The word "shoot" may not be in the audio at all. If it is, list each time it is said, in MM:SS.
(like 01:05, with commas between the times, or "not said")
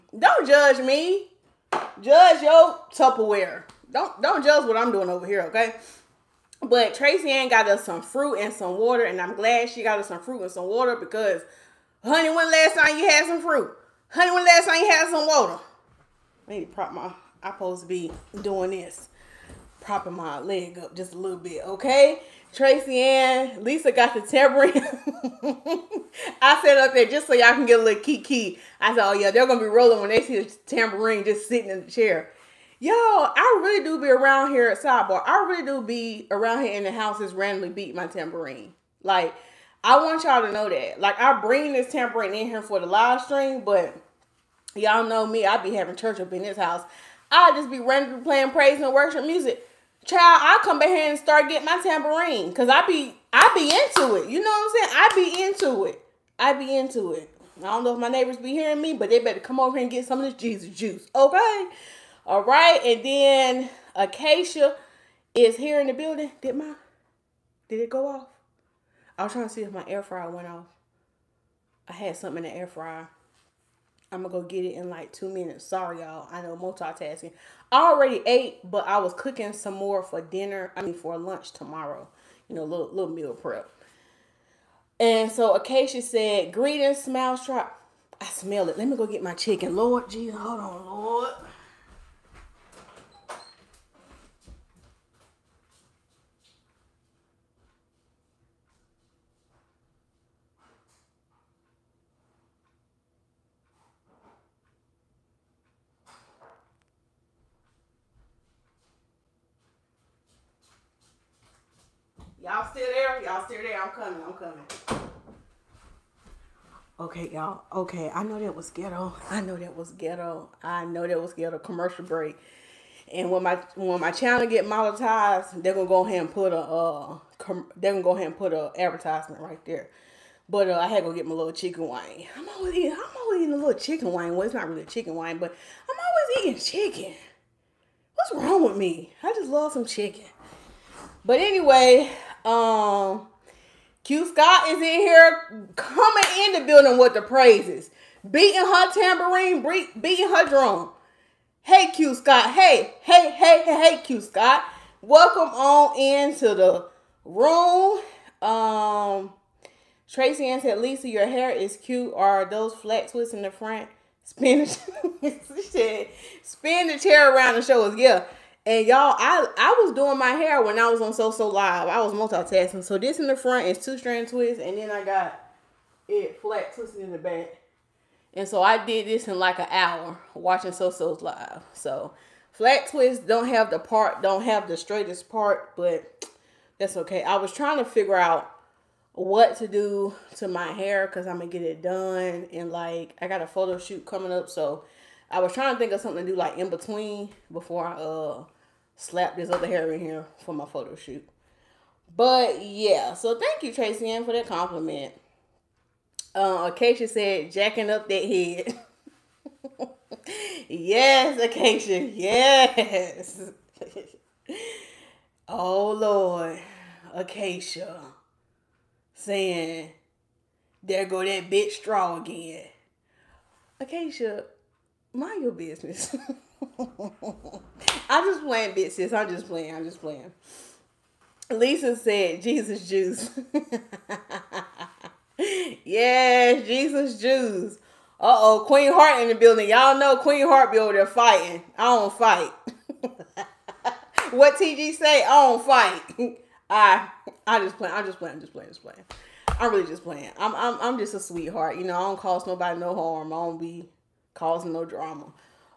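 03:13, 03:20.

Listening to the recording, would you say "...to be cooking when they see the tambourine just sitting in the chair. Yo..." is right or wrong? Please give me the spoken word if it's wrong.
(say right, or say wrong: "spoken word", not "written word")
wrong: "rolling", not "cooking".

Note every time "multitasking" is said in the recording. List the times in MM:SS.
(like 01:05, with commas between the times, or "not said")
01:16, 02:52.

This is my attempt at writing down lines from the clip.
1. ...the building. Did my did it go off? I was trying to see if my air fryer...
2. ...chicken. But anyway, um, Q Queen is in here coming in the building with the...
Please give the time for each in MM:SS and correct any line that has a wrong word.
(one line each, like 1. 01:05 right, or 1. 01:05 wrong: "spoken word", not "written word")
1. 01:05 right
2. 02:19 wrong: "Scott", not "Queen".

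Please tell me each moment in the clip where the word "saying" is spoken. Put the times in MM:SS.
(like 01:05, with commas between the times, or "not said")
00:54, 03:39.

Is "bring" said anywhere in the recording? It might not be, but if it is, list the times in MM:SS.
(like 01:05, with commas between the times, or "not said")
00:41.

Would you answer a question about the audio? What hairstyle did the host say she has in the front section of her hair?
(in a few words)
two strand twists.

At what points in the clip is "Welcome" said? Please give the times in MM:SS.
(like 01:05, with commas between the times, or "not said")
02:35.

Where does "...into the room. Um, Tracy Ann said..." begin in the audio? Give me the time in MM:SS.
02:35.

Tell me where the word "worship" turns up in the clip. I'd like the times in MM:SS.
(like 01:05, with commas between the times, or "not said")
00:48.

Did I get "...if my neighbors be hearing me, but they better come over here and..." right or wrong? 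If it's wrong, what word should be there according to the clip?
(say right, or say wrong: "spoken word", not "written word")
right.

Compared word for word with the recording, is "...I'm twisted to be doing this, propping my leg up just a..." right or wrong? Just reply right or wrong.
wrong.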